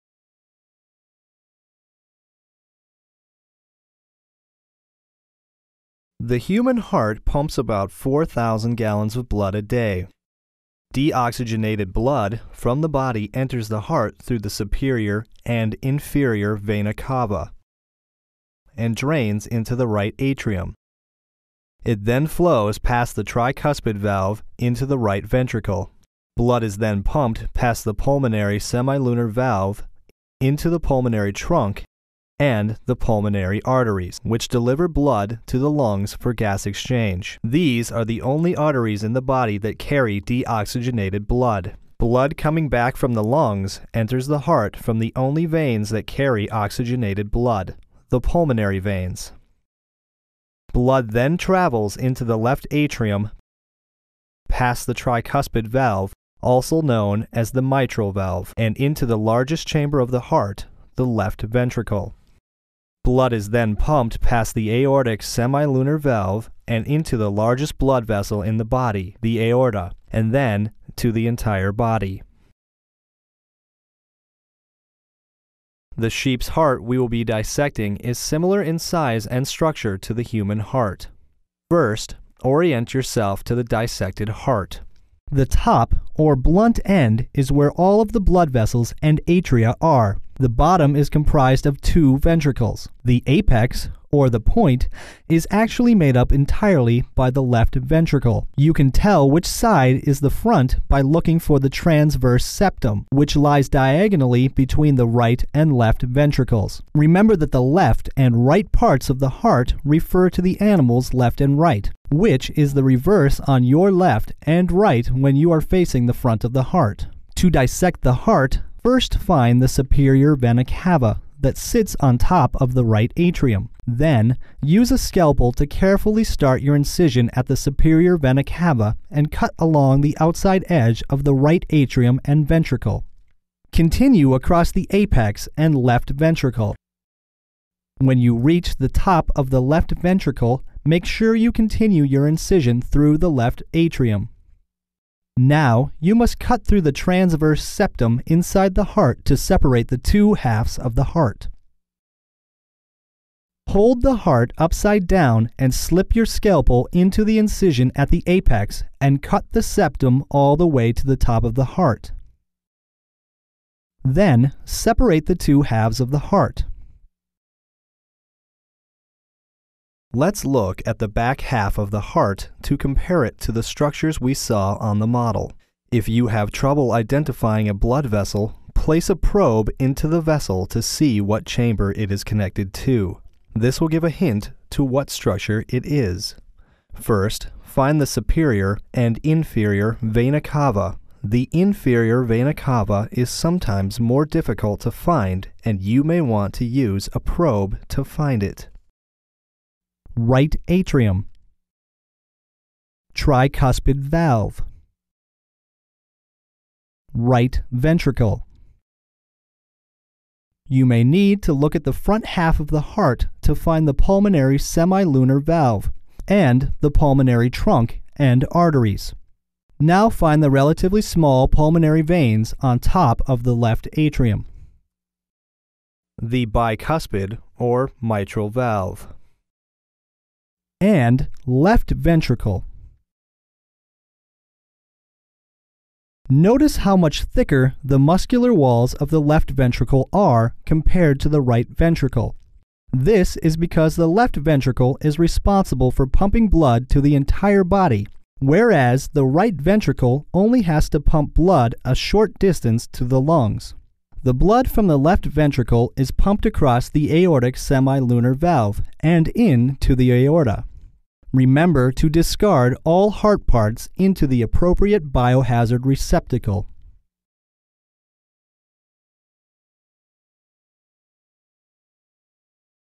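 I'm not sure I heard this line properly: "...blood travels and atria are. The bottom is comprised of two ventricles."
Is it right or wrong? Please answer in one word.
wrong.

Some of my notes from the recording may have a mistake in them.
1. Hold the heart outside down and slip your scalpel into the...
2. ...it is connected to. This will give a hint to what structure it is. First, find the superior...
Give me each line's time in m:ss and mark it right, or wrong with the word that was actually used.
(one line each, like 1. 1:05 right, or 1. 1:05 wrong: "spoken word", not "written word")
1. 2:33 wrong: "upside", not "outside"
2. 3:01 right.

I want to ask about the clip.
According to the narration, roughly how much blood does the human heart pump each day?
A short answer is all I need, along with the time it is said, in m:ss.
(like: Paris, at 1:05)
4,000 gallons, at 0:07.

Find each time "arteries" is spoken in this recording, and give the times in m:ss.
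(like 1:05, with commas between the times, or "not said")
0:33, 0:38, 3:38.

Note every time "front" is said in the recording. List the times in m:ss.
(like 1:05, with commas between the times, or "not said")
1:40, 1:56, 3:31.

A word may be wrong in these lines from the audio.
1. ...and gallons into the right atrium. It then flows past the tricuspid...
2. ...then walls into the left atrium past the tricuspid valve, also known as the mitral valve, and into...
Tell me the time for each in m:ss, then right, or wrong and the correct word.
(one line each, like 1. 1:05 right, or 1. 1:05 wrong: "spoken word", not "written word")
1. 0:18 wrong: "drains", not "gallons"
2. 0:51 wrong: "travels", not "walls".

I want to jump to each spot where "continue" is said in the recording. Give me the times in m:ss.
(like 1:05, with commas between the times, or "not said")
2:13, 2:21.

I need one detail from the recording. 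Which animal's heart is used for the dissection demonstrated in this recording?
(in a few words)
Sheep.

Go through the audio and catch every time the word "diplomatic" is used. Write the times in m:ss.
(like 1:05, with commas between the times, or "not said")
not said.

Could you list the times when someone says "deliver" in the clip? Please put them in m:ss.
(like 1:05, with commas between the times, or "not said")
0:34.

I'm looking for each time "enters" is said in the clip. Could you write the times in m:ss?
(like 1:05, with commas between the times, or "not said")
0:13, 0:43.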